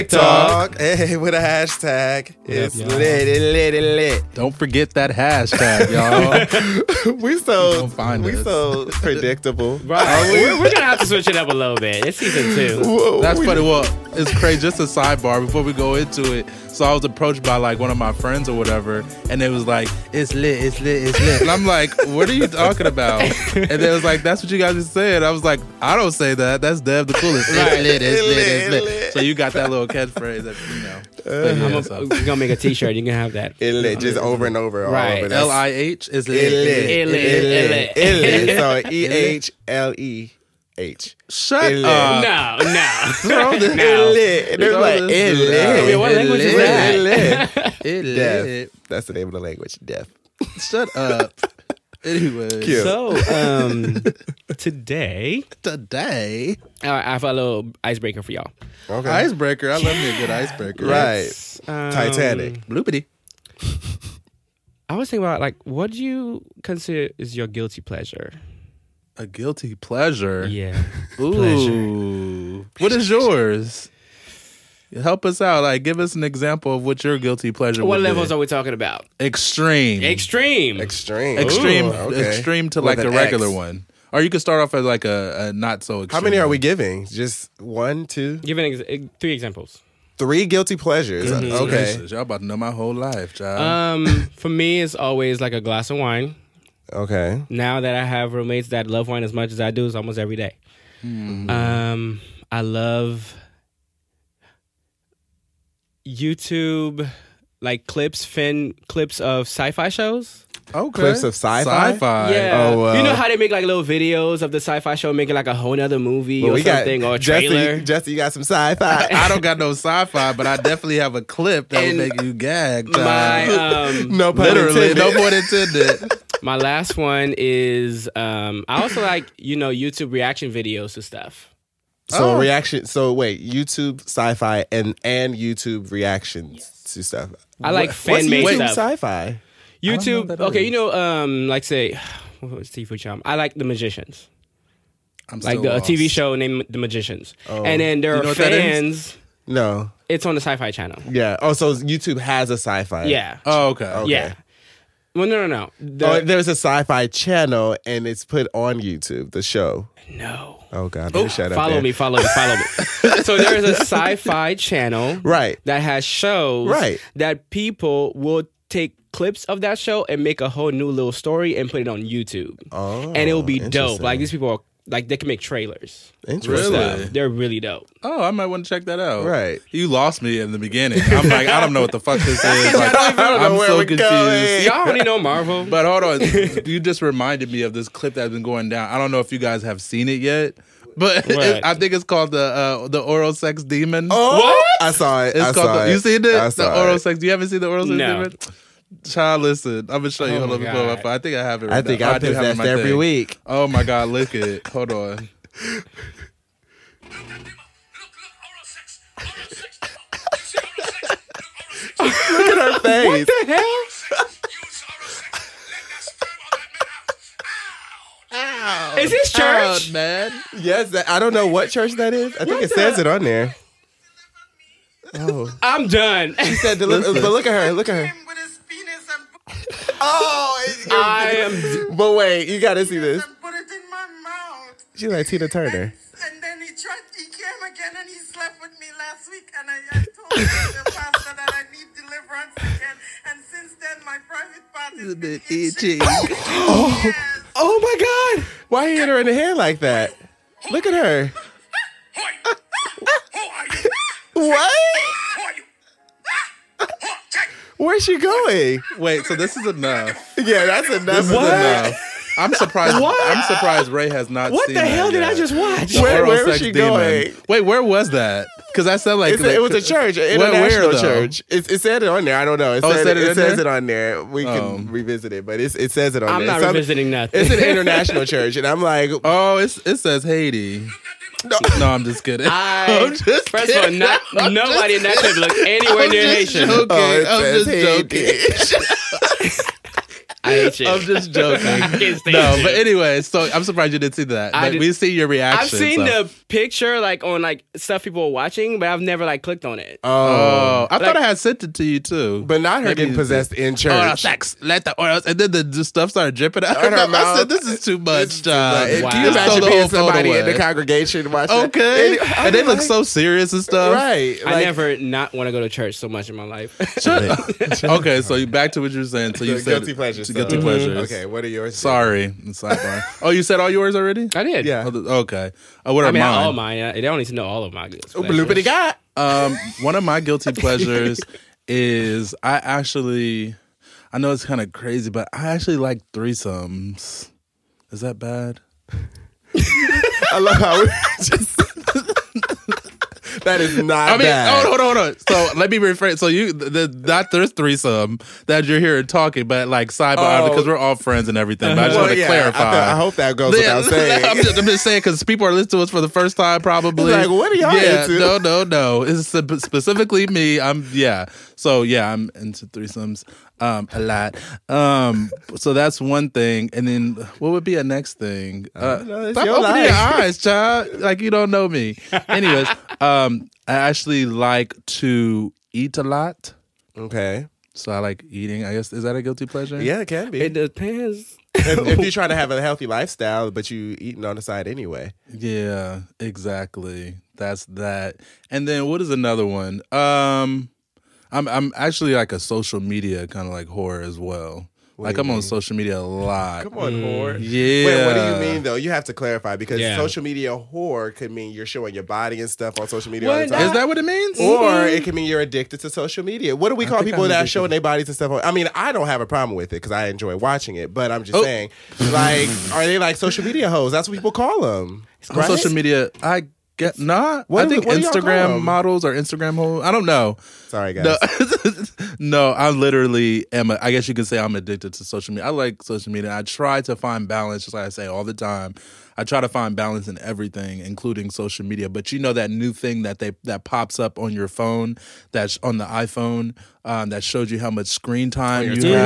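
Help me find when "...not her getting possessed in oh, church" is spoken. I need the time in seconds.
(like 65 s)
302 s.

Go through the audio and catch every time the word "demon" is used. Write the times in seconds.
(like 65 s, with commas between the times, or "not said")
193 s, 198 s, 266 s.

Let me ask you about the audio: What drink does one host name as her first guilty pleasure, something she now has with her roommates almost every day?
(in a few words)
A glass of wine.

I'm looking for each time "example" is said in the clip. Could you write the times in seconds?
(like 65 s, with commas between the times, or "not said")
76 s, 89 s.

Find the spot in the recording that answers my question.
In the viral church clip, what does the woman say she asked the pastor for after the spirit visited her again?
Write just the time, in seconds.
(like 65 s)
241 s.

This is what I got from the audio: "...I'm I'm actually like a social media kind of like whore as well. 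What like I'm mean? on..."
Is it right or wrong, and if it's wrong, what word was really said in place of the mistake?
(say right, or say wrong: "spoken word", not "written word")
right.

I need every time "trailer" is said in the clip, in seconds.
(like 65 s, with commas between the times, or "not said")
117 s, 175 s.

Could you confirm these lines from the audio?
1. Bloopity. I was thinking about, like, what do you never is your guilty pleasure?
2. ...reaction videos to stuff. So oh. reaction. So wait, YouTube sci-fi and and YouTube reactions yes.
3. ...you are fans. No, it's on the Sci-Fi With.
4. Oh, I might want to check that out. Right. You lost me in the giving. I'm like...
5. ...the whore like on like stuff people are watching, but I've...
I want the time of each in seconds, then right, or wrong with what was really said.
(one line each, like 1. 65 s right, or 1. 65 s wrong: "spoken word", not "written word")
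1. 62 s wrong: "consider", not "never"
2. 130 s right
3. 148 s wrong: "Channel", not "With"
4. 178 s wrong: "beginning", not "giving"
5. 296 s wrong: "picture", not "whore".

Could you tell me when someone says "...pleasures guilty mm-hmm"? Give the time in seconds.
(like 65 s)
319 s.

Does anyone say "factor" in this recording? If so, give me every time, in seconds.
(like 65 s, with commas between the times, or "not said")
not said.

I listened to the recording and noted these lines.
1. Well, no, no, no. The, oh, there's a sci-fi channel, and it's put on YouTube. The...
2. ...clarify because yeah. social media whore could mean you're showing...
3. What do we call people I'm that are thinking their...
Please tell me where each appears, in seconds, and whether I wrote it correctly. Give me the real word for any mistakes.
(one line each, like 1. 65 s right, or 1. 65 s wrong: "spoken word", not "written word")
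1. 155 s right
2. 399 s right
3. 406 s wrong: "showing", not "thinking".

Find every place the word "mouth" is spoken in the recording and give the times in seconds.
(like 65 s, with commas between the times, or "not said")
234 s, 307 s.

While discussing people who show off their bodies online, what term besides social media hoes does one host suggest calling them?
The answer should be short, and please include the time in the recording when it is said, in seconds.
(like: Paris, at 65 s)
Instagram models, at 417 s.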